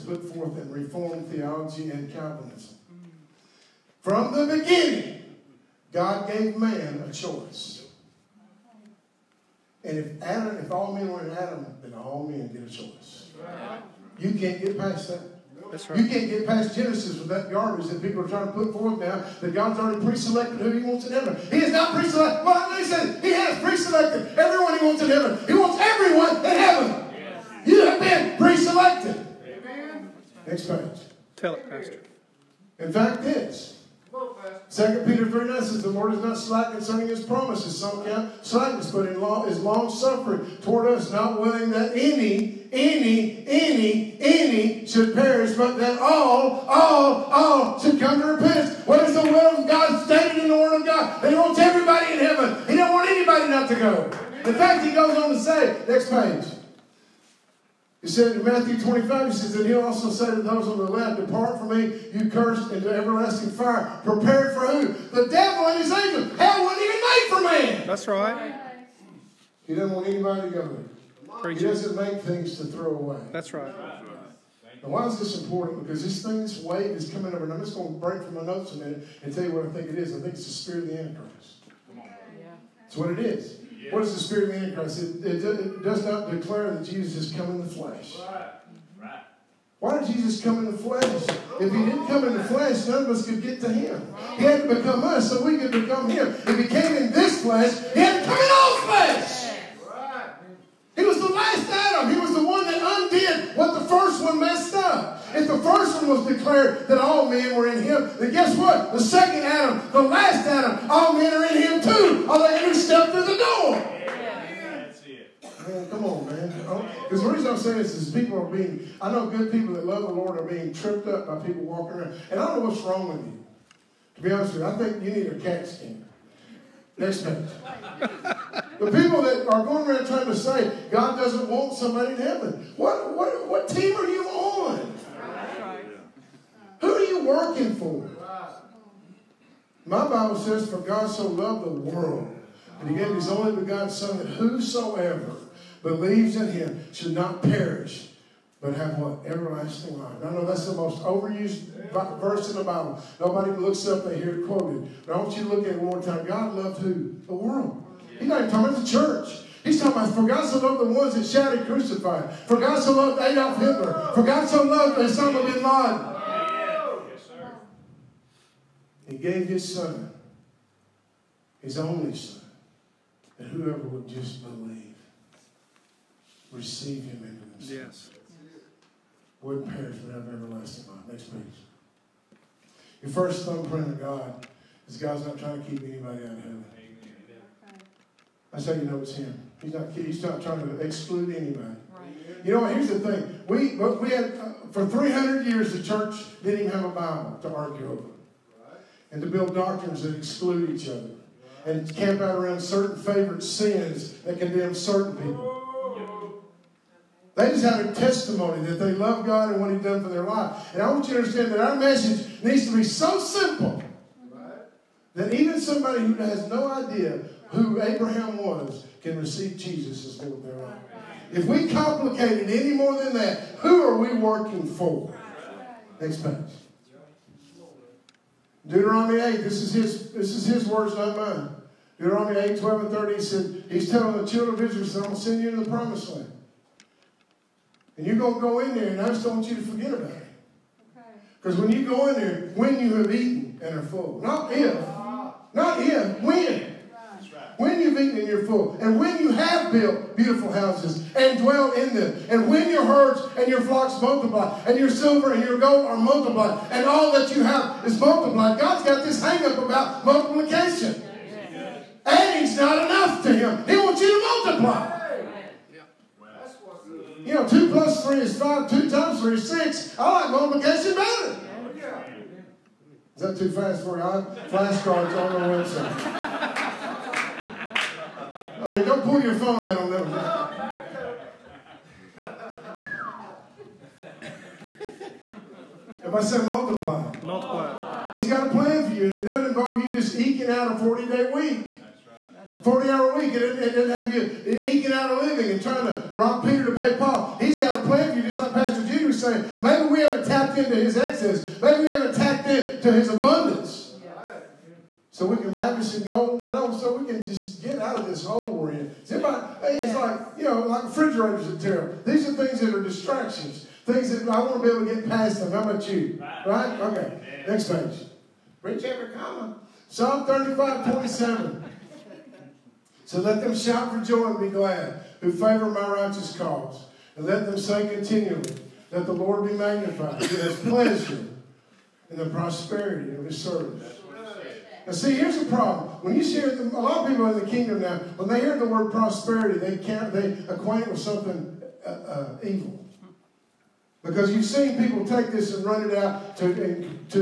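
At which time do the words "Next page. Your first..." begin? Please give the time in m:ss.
3:01.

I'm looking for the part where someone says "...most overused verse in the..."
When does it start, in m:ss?
2:30.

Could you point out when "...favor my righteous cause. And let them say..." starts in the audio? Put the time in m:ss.
5:25.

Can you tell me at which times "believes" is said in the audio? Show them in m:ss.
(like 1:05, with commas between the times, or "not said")
2:25, 2:54.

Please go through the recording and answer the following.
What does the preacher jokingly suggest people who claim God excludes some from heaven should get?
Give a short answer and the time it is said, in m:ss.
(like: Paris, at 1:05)
A CAT scan, at 2:05.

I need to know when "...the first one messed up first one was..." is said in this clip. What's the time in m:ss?
1:43.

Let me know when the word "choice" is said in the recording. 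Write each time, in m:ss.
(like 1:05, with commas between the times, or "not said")
0:07, 0:12.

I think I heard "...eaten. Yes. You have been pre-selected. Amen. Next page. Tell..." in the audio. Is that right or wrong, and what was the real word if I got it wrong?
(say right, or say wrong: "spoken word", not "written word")
wrong: "heaven", not "eaten".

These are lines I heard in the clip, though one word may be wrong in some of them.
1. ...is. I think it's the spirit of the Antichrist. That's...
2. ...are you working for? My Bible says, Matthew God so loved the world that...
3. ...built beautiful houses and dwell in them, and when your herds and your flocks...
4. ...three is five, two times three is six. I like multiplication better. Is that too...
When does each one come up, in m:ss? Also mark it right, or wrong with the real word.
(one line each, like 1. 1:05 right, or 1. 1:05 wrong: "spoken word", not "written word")
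1. 1:19 right
2. 2:16 wrong: "For", not "Matthew"
3. 4:09 right
4. 4:28 right.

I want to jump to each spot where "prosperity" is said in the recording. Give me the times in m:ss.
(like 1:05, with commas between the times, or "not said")
5:32, 5:38.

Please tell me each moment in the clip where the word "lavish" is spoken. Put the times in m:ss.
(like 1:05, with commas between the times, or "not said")
5:05.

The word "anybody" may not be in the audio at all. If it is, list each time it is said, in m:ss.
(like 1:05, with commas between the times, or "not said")
0:53, 1:10, 3:05, 3:11.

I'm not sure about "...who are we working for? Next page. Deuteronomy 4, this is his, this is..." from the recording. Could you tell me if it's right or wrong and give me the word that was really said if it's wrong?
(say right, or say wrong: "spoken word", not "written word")
wrong: "8", not "4".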